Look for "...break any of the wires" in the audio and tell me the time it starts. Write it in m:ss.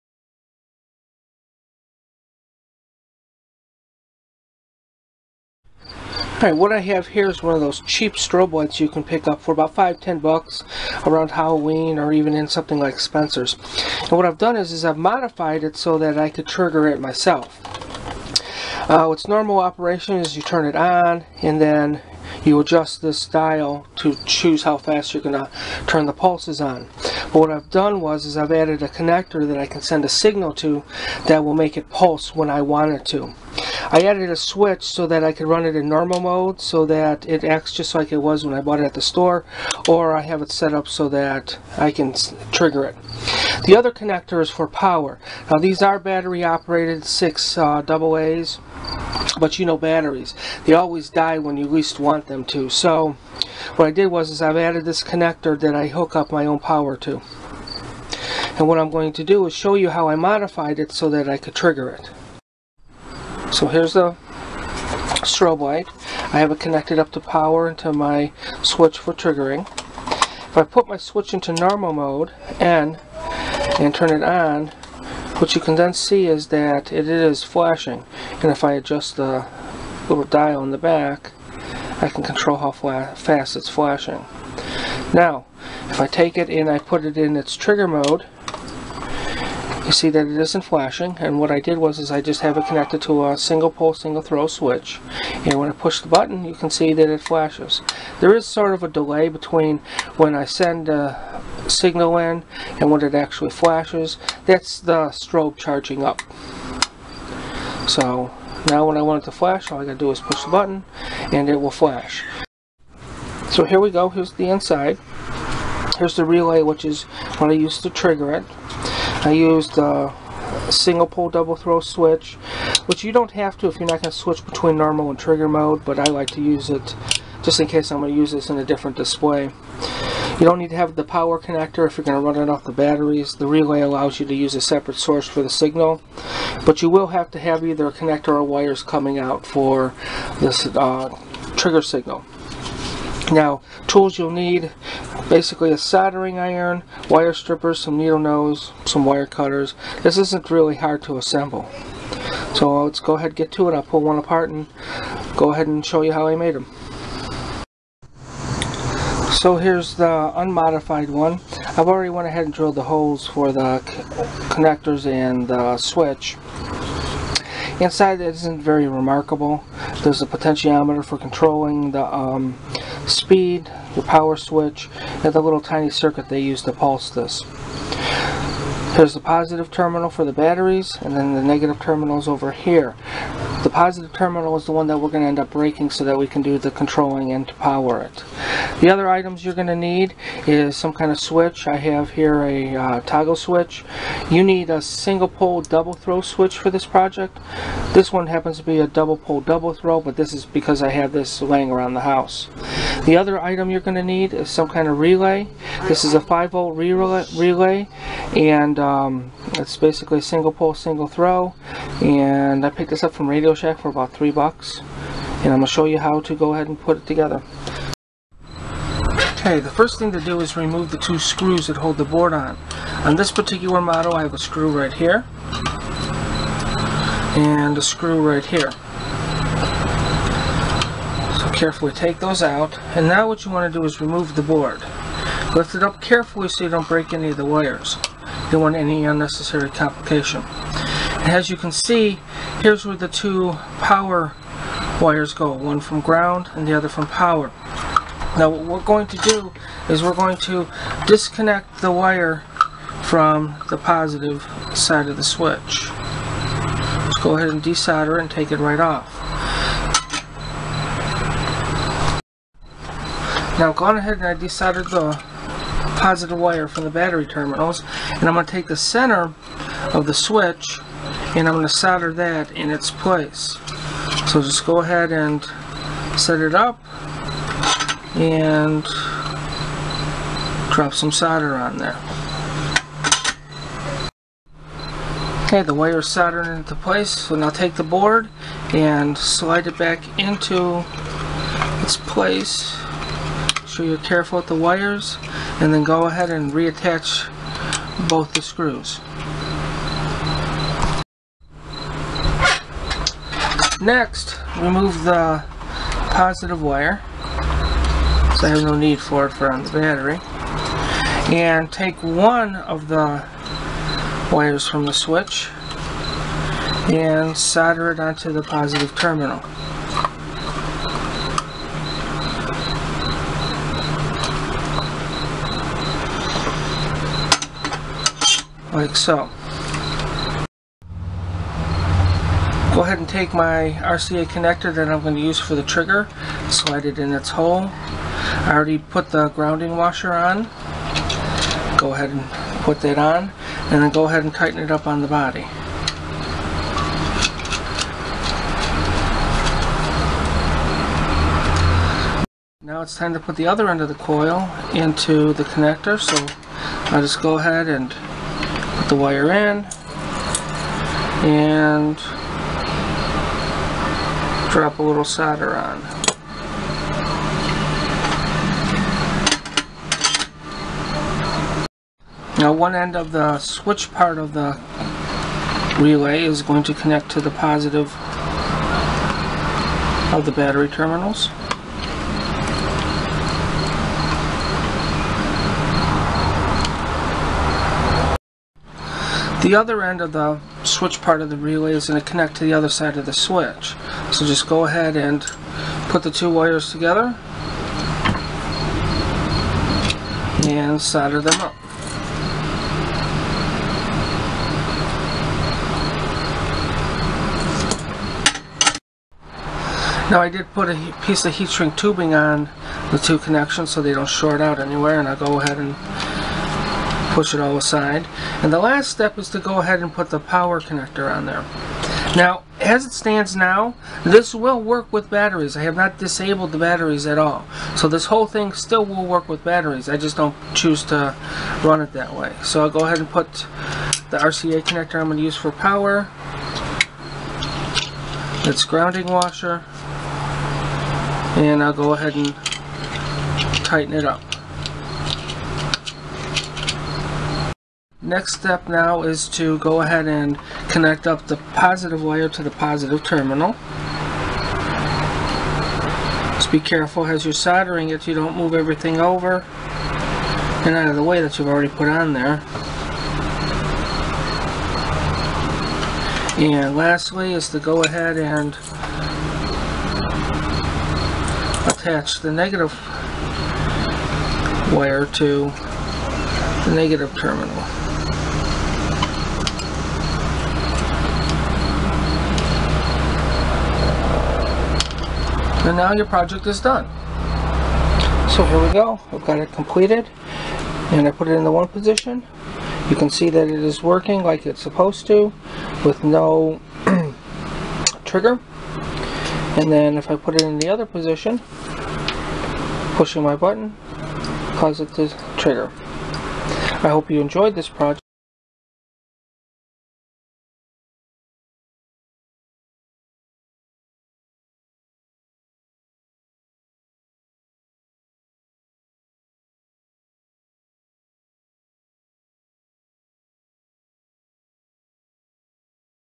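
3:56.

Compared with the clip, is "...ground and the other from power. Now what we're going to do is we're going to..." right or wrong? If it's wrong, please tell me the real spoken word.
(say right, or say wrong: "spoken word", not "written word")
right.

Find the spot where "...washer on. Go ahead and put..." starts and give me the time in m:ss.
5:39.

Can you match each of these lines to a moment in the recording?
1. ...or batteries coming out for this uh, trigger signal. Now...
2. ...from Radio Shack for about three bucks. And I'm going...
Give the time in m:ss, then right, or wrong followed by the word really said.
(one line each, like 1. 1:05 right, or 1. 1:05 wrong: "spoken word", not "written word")
1. 2:18 wrong: "wires", not "batteries"
2. 3:33 right.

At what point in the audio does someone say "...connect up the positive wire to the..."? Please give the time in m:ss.
7:30.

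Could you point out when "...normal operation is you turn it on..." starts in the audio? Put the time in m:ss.
0:19.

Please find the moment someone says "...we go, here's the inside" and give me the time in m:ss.
1:53.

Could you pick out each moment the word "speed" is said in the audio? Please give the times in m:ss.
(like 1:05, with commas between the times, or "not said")
2:53.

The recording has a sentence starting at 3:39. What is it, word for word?
Okay, the first thing to do is remove the two screws that hold the board on.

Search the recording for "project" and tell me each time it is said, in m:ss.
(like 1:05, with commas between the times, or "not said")
3:16, 8:06, 8:27.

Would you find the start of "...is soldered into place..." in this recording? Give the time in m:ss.
4:45.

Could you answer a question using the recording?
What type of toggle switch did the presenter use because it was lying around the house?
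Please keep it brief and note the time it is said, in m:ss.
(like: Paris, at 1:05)
double pole double throw, at 3:18.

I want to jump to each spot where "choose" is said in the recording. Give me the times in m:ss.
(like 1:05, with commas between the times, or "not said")
0:24, 7:10.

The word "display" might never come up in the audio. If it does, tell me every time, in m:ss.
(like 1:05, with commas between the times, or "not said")
2:08.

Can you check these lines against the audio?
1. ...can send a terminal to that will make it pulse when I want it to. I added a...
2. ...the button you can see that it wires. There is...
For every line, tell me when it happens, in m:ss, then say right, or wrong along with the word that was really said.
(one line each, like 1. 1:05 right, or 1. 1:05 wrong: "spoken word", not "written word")
1. 0:29 wrong: "signal", not "terminal"
2. 1:35 wrong: "flashes", not "wires".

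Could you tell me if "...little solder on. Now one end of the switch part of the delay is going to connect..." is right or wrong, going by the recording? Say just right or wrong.
wrong.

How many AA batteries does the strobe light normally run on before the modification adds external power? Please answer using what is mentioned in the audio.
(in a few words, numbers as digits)
6.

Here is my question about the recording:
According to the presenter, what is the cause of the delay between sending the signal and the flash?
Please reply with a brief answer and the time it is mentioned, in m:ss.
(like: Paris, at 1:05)
strobe charging up, at 1:45.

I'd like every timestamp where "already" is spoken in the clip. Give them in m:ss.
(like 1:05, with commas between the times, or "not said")
2:41, 5:38, 7:41.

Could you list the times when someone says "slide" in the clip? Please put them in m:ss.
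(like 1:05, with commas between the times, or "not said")
4:49, 5:36.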